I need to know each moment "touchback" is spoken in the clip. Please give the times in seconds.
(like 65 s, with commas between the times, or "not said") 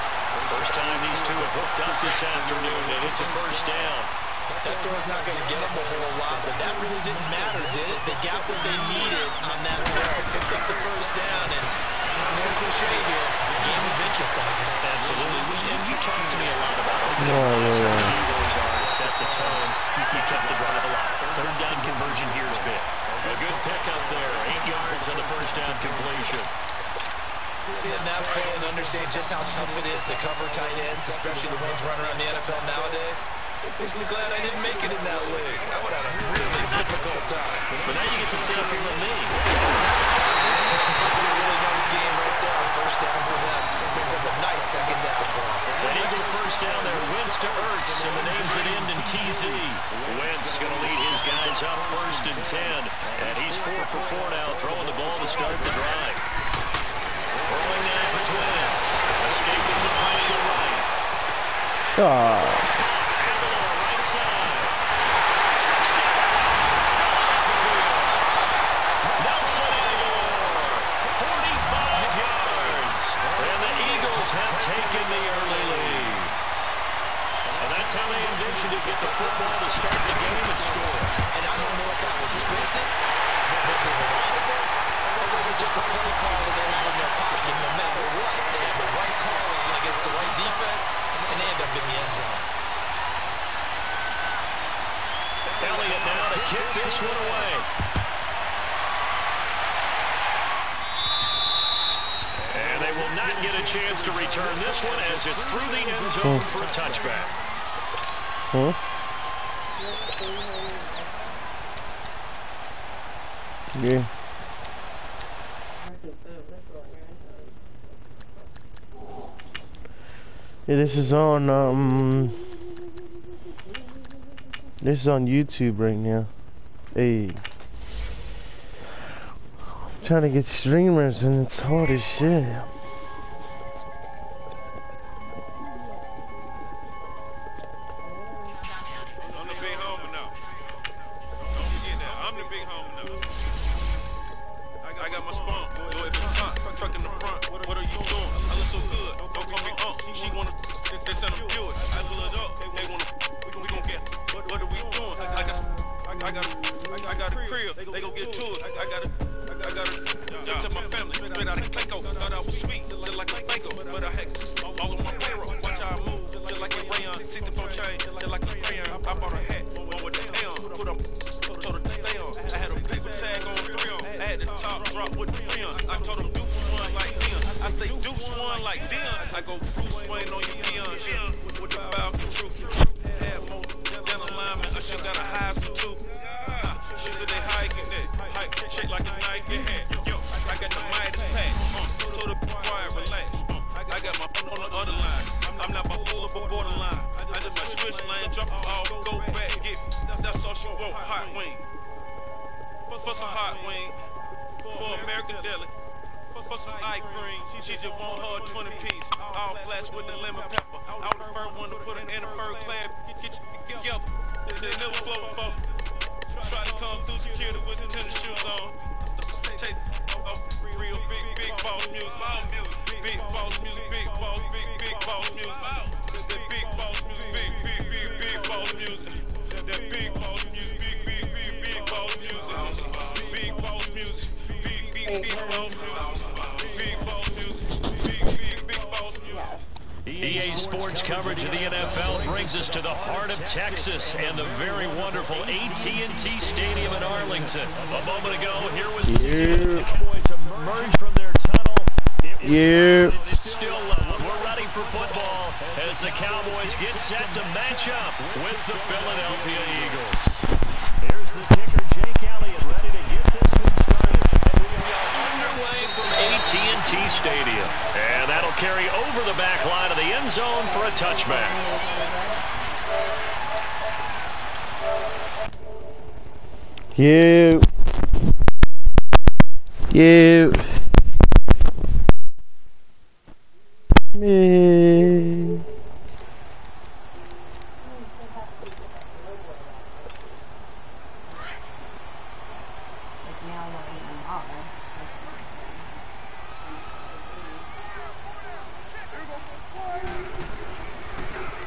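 106 s, 270 s.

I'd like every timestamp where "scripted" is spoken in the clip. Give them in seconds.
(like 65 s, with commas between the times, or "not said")
82 s.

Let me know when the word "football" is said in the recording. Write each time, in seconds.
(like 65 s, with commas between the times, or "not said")
79 s, 254 s.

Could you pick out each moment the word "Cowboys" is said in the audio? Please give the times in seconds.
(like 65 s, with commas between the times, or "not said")
249 s, 256 s.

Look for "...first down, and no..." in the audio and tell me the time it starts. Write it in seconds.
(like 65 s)
10 s.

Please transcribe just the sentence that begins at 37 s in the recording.
But now you get to sit up here with me first down for them.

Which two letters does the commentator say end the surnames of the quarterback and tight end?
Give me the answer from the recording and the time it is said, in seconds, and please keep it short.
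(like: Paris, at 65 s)
TZ, at 49 s.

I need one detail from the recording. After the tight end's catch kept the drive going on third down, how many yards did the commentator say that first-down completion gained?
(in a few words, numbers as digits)
8.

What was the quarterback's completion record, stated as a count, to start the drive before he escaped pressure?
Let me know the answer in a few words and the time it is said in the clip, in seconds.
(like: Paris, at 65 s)
4 for 4, at 53 s.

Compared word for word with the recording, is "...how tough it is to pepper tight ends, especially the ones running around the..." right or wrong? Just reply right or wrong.
wrong.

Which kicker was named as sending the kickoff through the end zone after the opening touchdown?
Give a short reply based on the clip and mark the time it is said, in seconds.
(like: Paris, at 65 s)
Elliott, at 95 s.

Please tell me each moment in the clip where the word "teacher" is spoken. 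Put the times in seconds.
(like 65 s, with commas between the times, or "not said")
not said.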